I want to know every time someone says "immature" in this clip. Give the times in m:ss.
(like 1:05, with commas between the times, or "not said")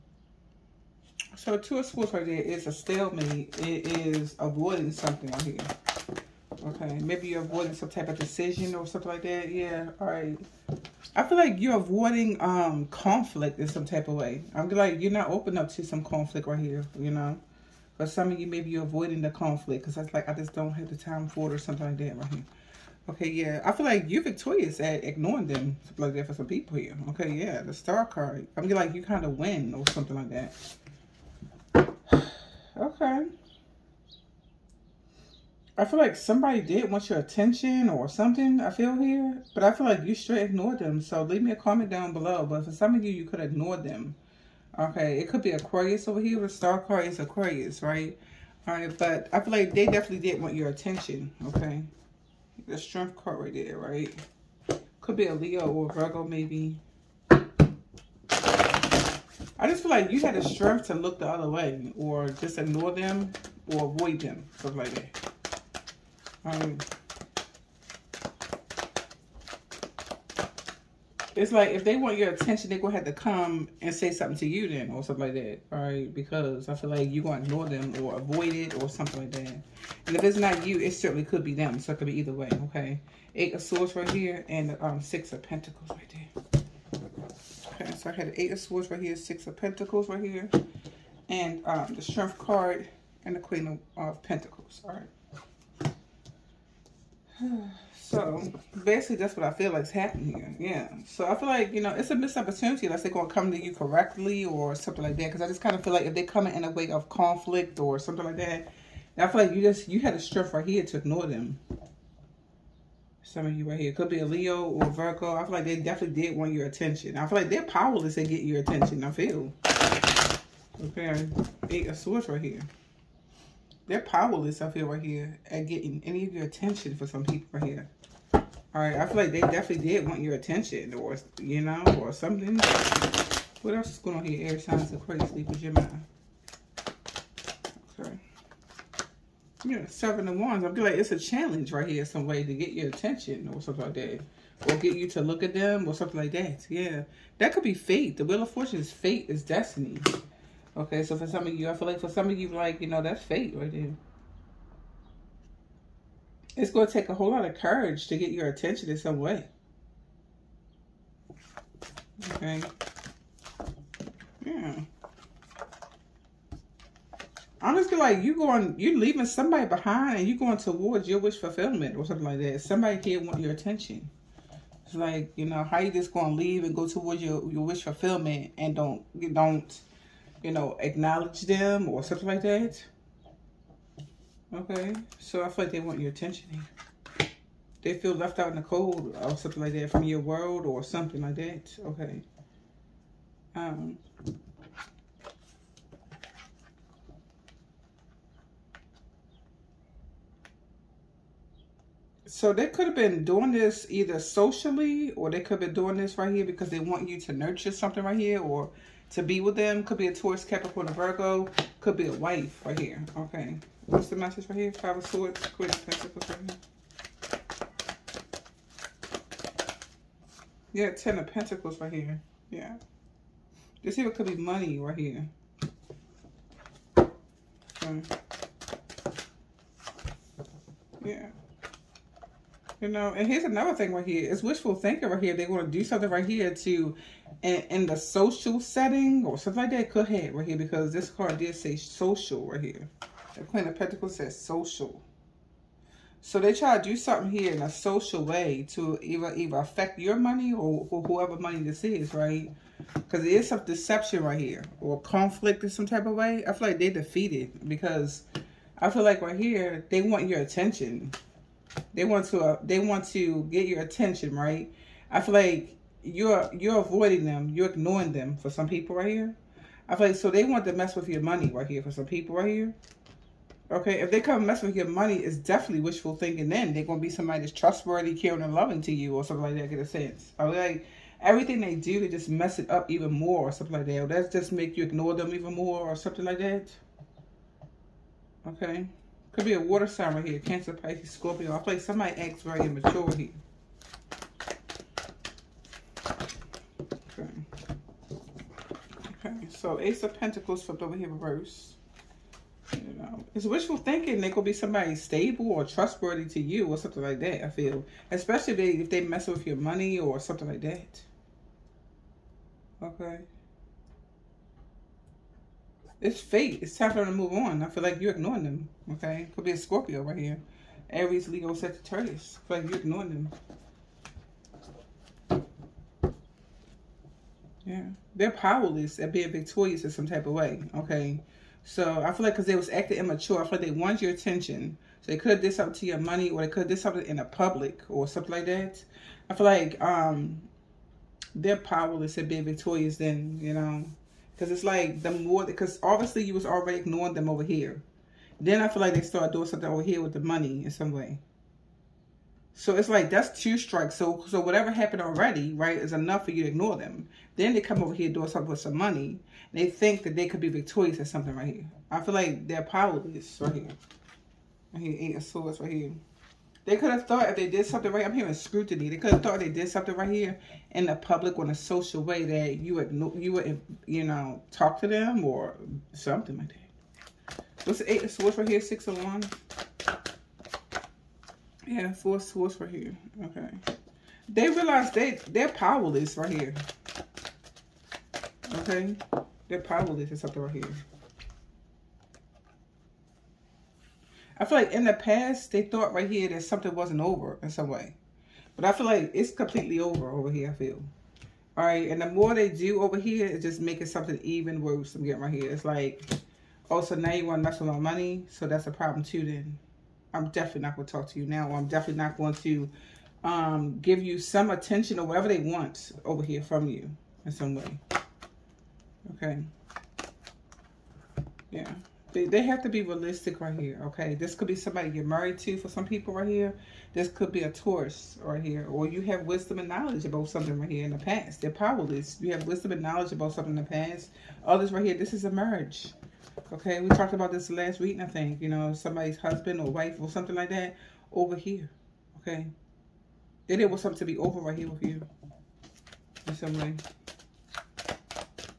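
4:52, 5:32.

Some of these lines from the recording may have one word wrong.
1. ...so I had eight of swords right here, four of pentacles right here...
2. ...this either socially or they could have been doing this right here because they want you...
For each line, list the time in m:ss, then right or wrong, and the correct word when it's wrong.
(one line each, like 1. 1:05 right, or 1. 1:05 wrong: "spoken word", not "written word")
1. 1:27 wrong: "six", not "four"
2. 3:23 right.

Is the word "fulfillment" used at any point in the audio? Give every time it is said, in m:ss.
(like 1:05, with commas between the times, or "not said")
2:51, 2:57.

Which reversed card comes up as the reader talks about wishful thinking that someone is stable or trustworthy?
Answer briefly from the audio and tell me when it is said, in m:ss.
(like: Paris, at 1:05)
Ace of Pentacles, at 4:59.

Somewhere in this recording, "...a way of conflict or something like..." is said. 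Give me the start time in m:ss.
1:46.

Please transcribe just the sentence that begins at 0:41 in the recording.
So leave me a comment down below.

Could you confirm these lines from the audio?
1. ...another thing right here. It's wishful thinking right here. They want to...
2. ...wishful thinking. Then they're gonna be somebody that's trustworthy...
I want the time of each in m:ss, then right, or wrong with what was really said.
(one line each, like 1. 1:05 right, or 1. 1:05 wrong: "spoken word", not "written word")
1. 3:53 right
2. 4:35 right.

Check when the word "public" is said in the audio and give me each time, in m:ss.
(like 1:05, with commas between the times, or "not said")
5:37, 6:10.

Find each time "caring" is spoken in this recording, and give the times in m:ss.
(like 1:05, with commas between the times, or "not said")
4:38.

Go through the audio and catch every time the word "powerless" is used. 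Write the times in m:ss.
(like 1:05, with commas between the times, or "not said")
1:57, 2:04, 5:28, 5:41, 6:02, 6:25, 6:29, 7:11.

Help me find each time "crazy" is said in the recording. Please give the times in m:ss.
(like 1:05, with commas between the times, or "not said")
2:14.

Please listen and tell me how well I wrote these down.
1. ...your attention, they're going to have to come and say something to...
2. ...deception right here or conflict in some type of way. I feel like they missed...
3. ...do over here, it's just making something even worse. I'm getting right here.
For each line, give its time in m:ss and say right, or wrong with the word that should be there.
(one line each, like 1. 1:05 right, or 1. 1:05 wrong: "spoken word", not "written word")
1. 1:12 right
2. 4:13 wrong: "defeated", not "missed"
3. 6:42 right.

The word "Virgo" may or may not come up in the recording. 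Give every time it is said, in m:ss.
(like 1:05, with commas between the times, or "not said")
0:55, 1:54, 3:30.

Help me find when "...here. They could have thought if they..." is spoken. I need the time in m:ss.
6:05.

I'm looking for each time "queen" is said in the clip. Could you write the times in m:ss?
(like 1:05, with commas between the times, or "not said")
1:33, 3:35, 4:03.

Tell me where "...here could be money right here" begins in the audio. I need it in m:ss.
3:43.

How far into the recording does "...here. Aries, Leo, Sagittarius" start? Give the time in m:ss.
5:20.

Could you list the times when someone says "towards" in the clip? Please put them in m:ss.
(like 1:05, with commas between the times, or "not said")
2:50, 2:56.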